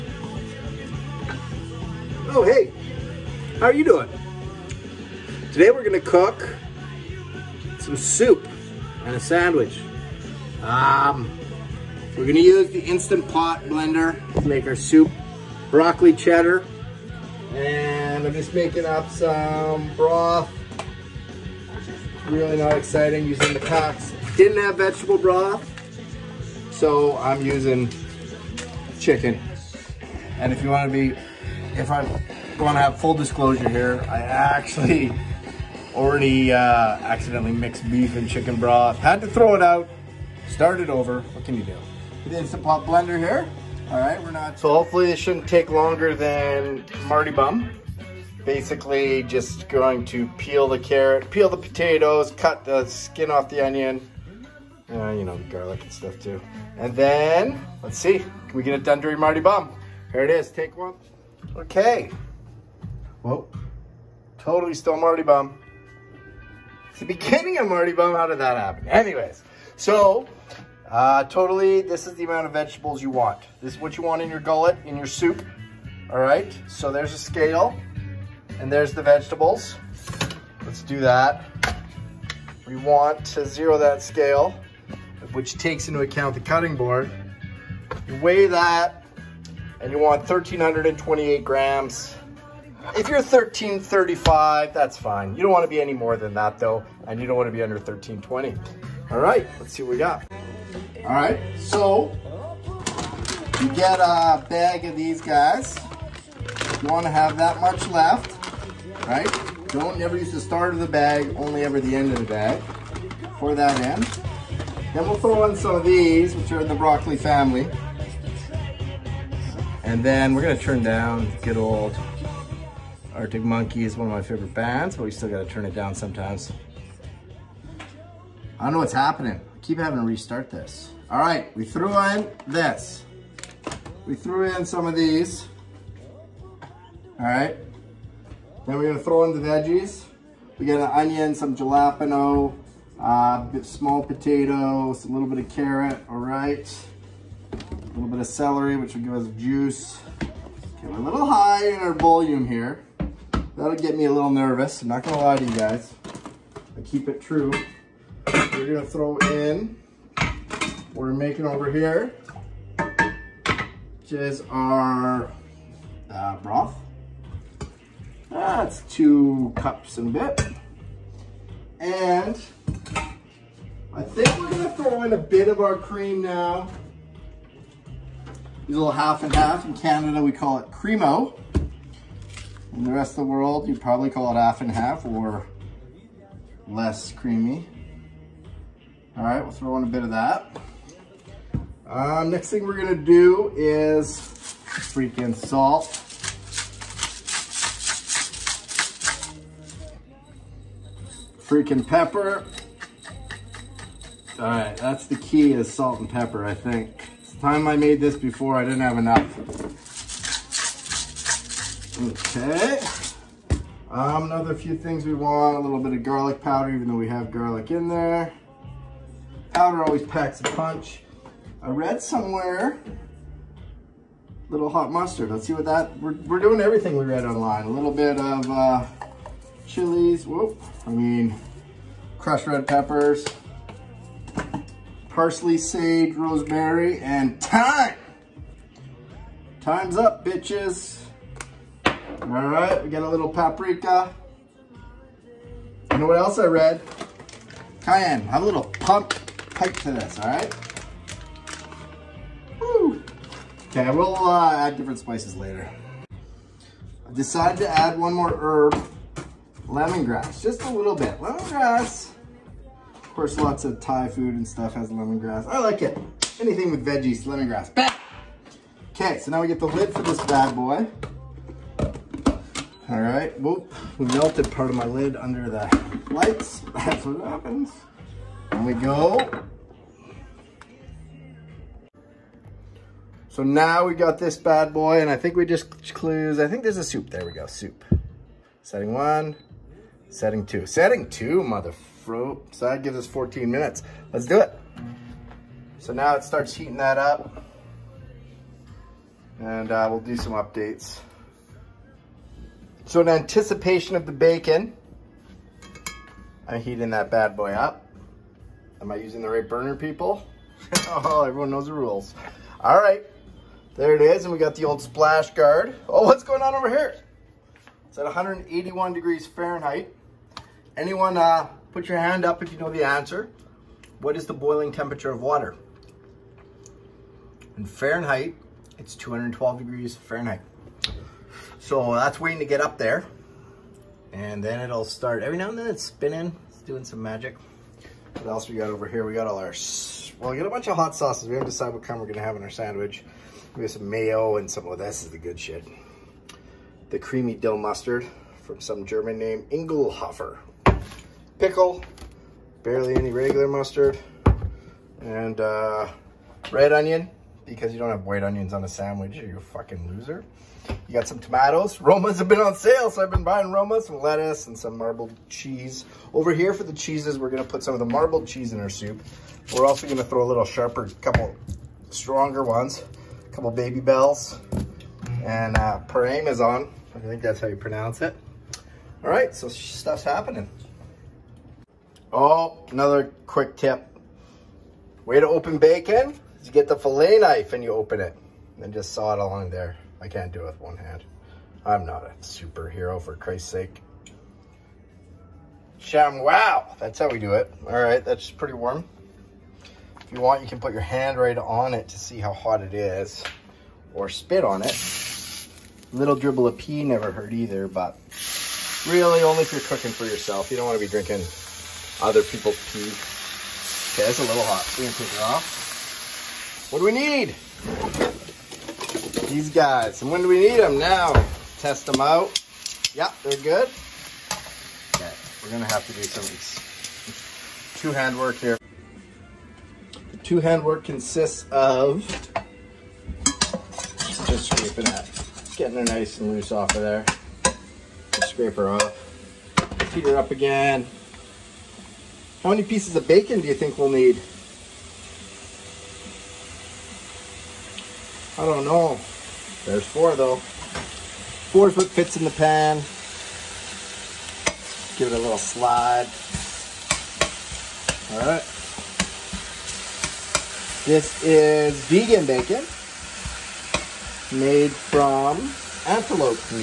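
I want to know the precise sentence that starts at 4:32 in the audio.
All right, whoop, we melted part of my lid under the lights.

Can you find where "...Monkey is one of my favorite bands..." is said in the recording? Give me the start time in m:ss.
2:03.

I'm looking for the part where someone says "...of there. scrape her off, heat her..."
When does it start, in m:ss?
7:16.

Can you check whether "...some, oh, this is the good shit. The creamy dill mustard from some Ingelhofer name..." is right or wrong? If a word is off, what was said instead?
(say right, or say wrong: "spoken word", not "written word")
wrong: "German", not "Ingelhofer".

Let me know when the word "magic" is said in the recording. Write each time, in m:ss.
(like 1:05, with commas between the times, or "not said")
5:37.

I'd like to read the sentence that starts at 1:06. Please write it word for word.
It's the beginning of Mardy Bum.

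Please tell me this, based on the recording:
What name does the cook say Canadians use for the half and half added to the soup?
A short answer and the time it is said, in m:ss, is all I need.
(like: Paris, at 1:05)
Cremo, at 3:00.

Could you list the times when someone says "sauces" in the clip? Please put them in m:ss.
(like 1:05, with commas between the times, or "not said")
5:40.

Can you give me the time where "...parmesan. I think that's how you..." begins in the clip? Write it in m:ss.
6:15.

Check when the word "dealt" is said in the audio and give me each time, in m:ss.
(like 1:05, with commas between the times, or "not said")
not said.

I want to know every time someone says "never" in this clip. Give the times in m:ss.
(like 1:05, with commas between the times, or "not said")
1:49, 6:46.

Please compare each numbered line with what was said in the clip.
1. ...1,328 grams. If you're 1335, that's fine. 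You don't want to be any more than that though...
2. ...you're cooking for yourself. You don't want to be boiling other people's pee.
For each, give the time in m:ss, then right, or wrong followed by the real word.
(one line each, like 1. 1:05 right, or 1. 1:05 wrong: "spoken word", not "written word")
1. 1:30 right
2. 6:49 wrong: "drinking", not "boiling".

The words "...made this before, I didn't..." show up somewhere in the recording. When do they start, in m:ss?
3:27.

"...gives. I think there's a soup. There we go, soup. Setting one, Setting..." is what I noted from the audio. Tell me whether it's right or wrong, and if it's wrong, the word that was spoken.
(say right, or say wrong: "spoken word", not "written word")
wrong: "clues", not "gives".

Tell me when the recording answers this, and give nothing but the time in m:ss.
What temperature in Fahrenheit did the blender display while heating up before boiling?
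5:18.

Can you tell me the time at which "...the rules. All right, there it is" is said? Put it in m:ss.
5:11.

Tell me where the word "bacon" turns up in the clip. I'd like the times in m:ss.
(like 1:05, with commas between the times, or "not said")
5:04, 6:25, 7:23, 7:42.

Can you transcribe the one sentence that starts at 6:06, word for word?
Over here for the cheeses, we're gonna put some of the marbled cheese in our soup.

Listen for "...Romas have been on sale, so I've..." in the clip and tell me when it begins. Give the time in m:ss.
6:01.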